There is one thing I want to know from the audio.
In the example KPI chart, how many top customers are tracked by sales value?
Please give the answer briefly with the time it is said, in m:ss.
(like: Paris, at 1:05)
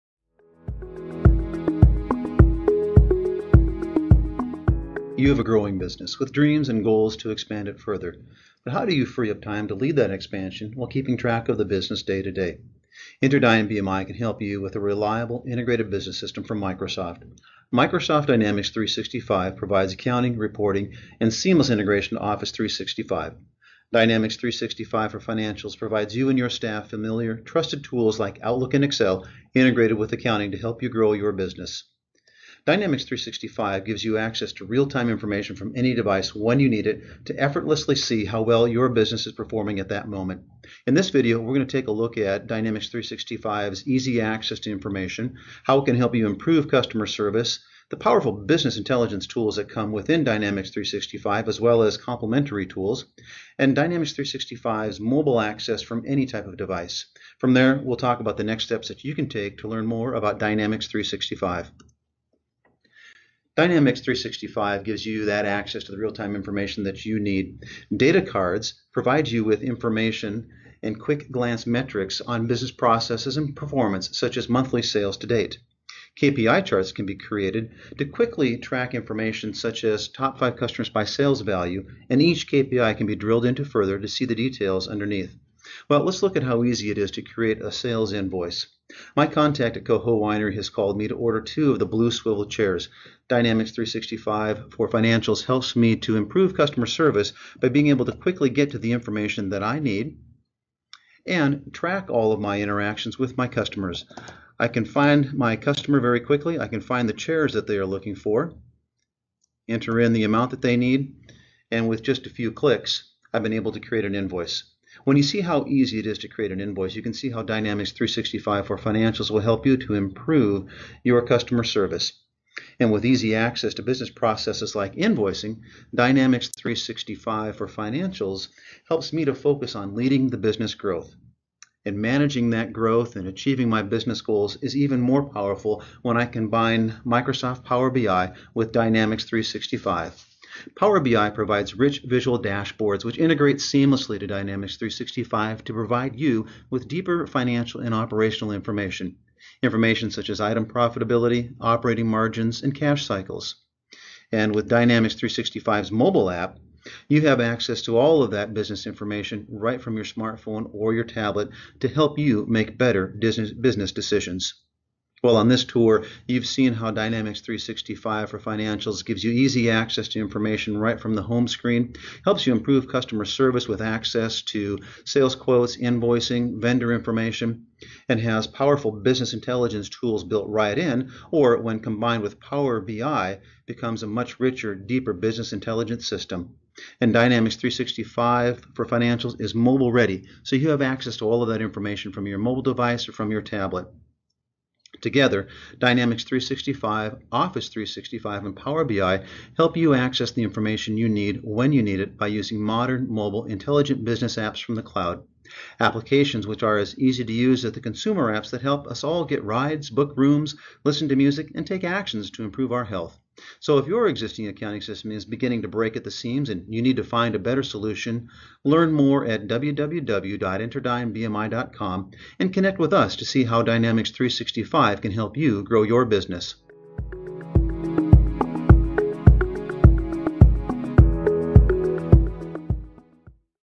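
5, at 1:20.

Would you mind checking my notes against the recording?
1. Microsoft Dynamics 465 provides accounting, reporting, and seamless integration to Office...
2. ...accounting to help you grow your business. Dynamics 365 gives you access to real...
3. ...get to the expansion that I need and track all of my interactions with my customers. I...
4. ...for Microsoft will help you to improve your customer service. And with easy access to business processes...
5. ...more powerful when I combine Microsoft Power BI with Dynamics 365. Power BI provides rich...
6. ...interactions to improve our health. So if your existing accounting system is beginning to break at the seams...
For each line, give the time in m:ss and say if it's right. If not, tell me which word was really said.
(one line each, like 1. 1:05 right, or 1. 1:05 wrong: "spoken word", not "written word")
1. 0:17 wrong: "365", not "465"
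2. 0:30 right
3. 1:38 wrong: "information", not "expansion"
4. 1:58 wrong: "Financials", not "Microsoft"
5. 2:14 right
6. 3:31 wrong: "actions", not "interactions".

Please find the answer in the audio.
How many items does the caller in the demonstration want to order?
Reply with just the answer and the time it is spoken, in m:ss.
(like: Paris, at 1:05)
2, at 1:31.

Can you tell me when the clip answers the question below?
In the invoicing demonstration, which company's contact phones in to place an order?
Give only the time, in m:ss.
1:29.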